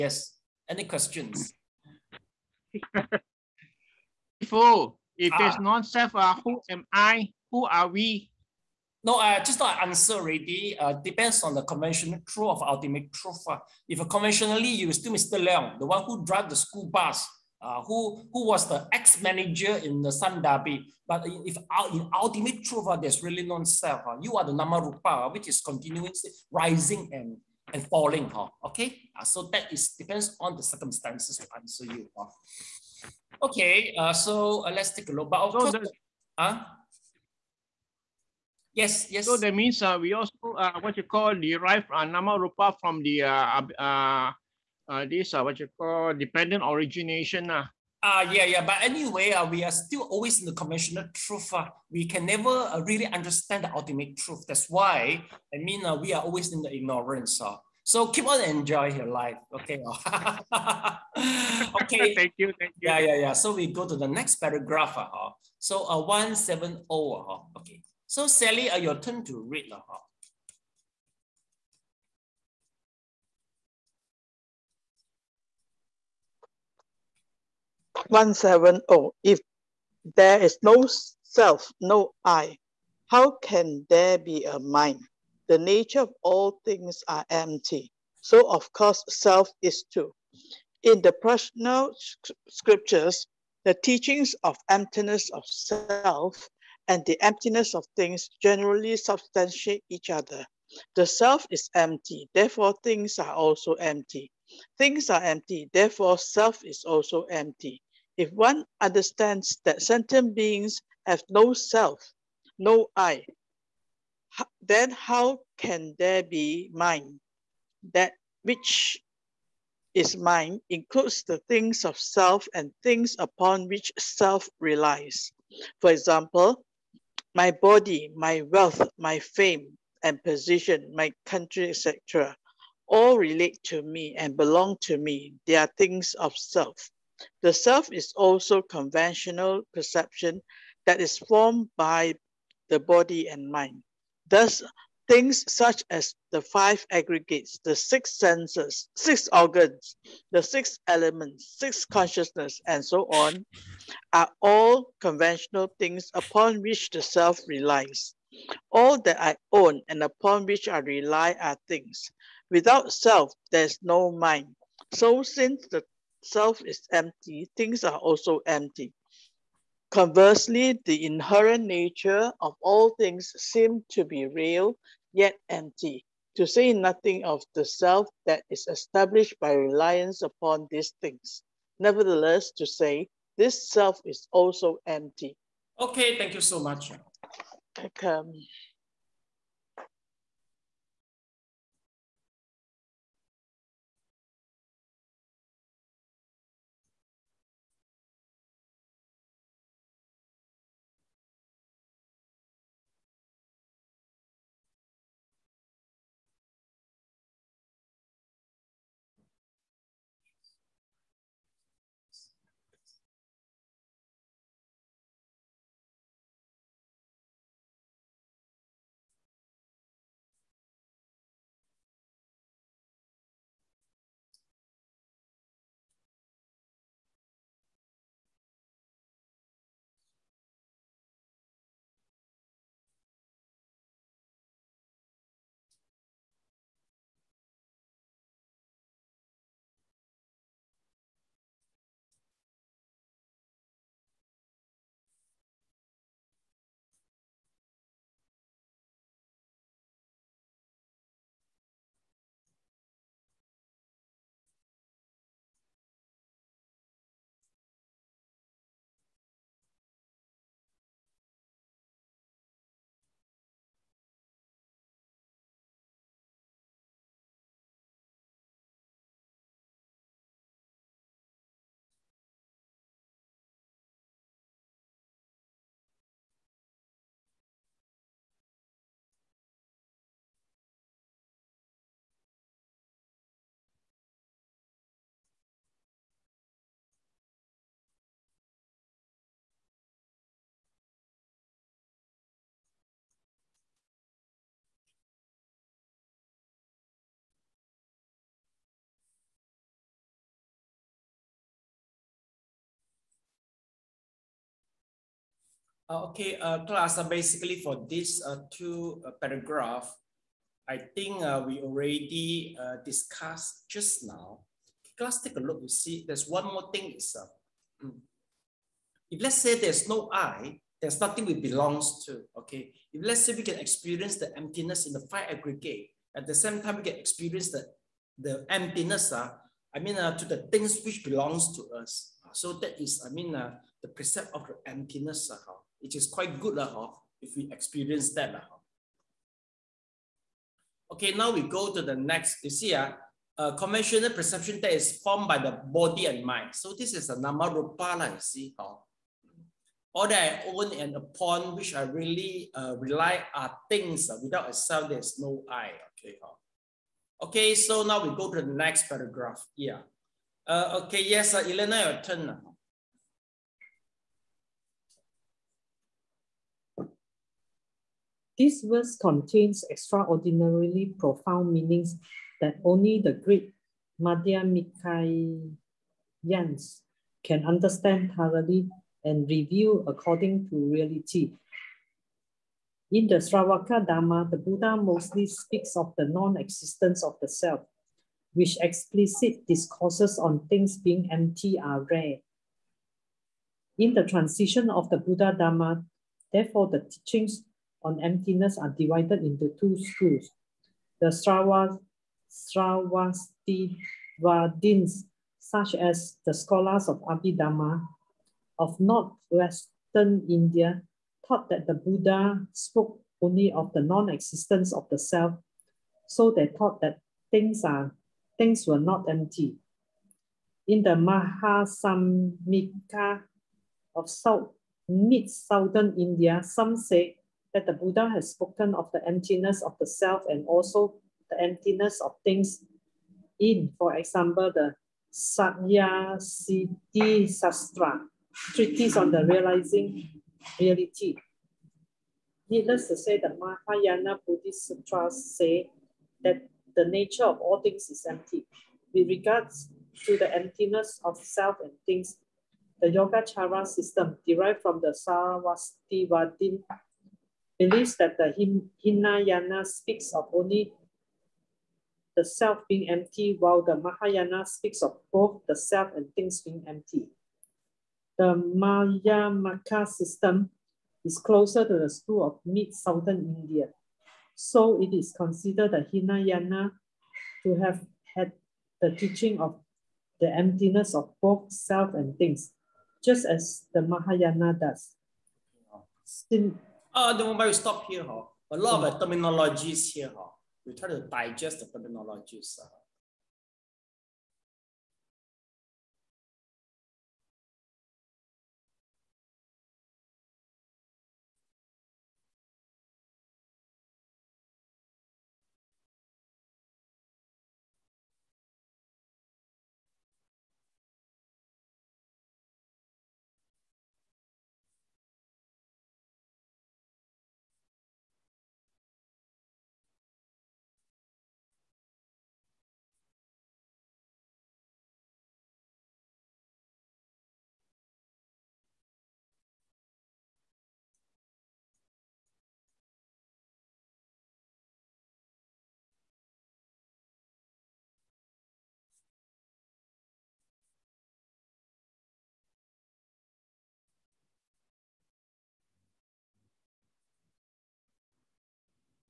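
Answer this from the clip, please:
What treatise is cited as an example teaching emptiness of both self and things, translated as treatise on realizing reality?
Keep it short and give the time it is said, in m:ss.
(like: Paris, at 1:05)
Satya Siddhi Sastra, at 7:15.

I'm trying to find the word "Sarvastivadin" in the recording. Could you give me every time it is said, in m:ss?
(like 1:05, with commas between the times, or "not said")
7:35.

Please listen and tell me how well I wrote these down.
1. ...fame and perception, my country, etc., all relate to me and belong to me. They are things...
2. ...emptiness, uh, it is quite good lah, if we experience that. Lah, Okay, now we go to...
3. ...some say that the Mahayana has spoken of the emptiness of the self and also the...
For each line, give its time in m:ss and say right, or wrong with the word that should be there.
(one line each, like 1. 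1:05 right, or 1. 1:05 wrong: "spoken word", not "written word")
1. 2:09 wrong: "position", not "perception"
2. 5:34 right
3. 7:06 wrong: "Buddha", not "Mahayana".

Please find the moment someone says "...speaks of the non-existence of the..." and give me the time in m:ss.
6:25.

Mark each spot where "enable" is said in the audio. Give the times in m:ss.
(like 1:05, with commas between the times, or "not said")
not said.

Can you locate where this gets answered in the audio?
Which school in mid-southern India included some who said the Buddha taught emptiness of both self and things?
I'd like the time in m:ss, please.
7:00.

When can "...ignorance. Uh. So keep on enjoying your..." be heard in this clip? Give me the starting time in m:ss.
0:56.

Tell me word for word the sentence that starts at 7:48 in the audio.
The Madhyamaka system is closer to the school of mid-southern India.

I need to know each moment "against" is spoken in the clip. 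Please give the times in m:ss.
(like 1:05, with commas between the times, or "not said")
not said.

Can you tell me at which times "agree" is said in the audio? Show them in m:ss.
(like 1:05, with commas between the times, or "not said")
not said.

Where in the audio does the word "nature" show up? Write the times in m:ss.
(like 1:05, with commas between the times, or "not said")
1:25, 2:51, 7:26.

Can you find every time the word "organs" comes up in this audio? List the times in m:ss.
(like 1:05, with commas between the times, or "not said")
2:29.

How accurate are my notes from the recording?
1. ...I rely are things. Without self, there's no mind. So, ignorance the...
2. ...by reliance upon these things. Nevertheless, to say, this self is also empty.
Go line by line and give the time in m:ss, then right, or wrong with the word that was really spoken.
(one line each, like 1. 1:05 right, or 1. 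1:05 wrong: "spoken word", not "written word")
1. 2:40 wrong: "since", not "ignorance"
2. 2:59 right.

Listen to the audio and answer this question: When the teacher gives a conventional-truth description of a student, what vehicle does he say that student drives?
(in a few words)
the school bus.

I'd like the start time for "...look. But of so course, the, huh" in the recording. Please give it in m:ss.
0:35.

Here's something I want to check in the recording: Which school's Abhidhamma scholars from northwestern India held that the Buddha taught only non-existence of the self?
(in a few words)
Sravastivadins.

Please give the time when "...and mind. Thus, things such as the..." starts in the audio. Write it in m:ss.
2:23.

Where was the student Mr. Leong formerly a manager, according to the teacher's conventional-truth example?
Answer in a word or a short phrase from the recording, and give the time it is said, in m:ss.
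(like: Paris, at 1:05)
Sun Derby, at 0:20.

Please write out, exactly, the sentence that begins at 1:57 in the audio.
That which is mind includes the things of self and things upon which self relies.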